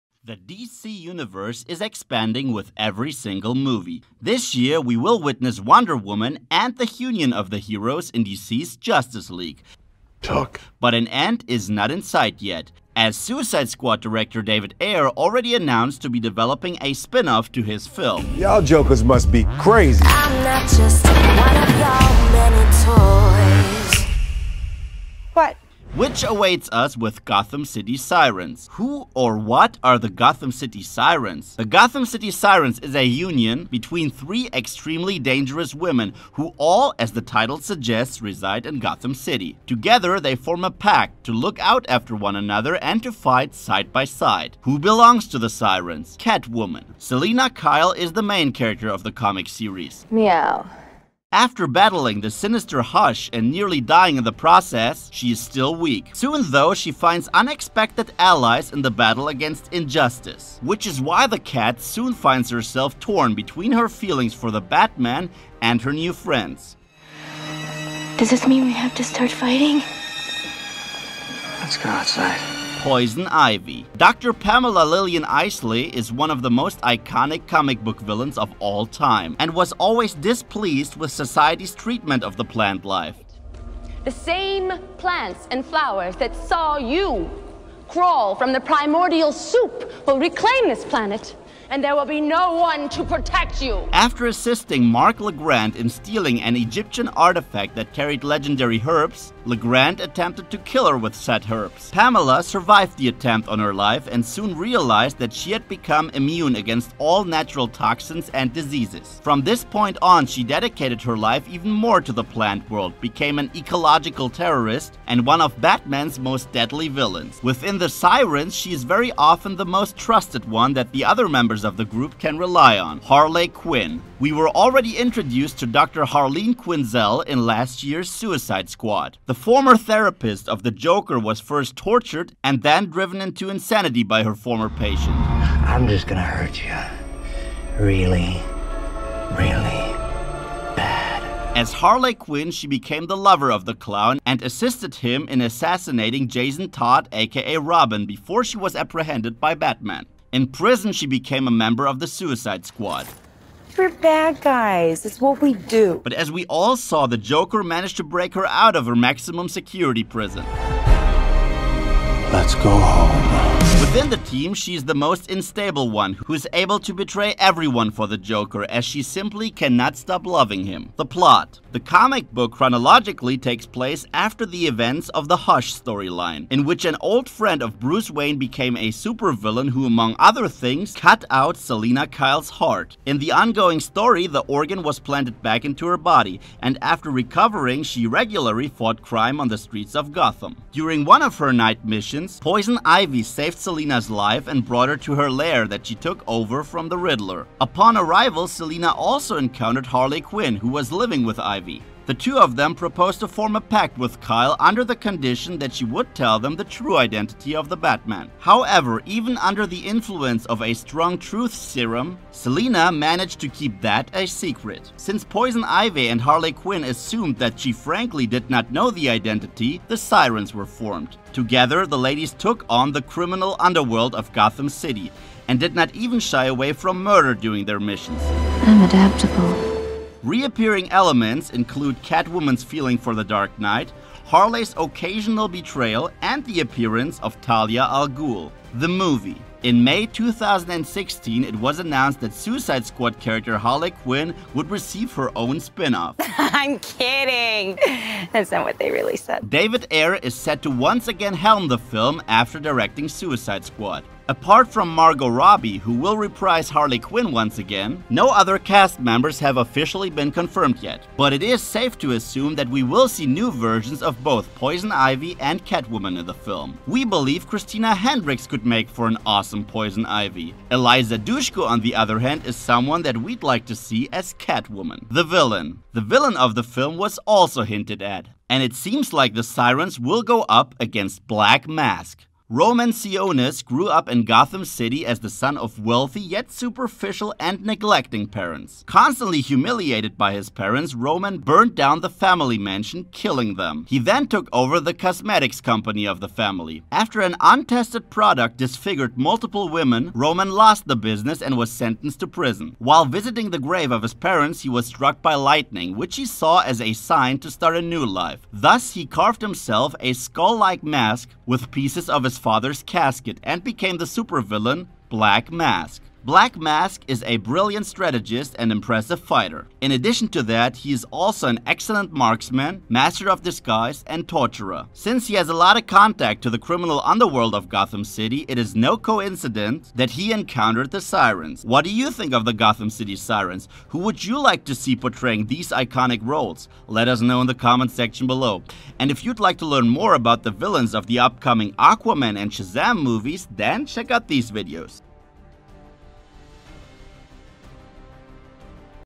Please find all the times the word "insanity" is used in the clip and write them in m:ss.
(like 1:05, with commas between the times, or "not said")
2:13.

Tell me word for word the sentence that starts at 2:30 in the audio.
In prison, she became a member of the Suicide Squad.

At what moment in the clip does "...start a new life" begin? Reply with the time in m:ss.
5:07.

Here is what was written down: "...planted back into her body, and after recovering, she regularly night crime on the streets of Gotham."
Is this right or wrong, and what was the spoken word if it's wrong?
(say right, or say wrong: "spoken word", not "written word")
wrong: "fought", not "night".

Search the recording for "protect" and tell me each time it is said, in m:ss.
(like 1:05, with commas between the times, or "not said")
1:33.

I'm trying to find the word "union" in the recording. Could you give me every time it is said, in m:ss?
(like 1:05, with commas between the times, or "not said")
0:06, 0:33.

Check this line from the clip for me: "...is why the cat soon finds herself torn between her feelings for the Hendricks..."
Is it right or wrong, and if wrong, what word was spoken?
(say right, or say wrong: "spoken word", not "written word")
wrong: "Batman", not "Hendricks".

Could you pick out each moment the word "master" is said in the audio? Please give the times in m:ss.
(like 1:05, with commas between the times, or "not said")
5:22.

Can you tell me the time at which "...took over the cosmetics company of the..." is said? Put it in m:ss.
4:54.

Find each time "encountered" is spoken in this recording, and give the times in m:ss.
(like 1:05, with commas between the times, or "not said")
3:19, 5:30.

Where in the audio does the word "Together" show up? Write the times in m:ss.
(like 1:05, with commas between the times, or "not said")
0:39, 3:41.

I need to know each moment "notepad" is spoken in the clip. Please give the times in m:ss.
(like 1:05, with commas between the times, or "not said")
not said.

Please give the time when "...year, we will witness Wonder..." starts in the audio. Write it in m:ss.
0:04.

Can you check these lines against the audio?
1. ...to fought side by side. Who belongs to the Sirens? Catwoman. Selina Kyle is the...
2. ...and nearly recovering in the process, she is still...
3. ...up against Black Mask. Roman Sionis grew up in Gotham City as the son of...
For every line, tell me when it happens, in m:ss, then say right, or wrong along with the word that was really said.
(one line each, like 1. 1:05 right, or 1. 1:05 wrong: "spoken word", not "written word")
1. 0:43 wrong: "fight", not "fought"
2. 0:53 wrong: "dying", not "recovering"
3. 4:40 right.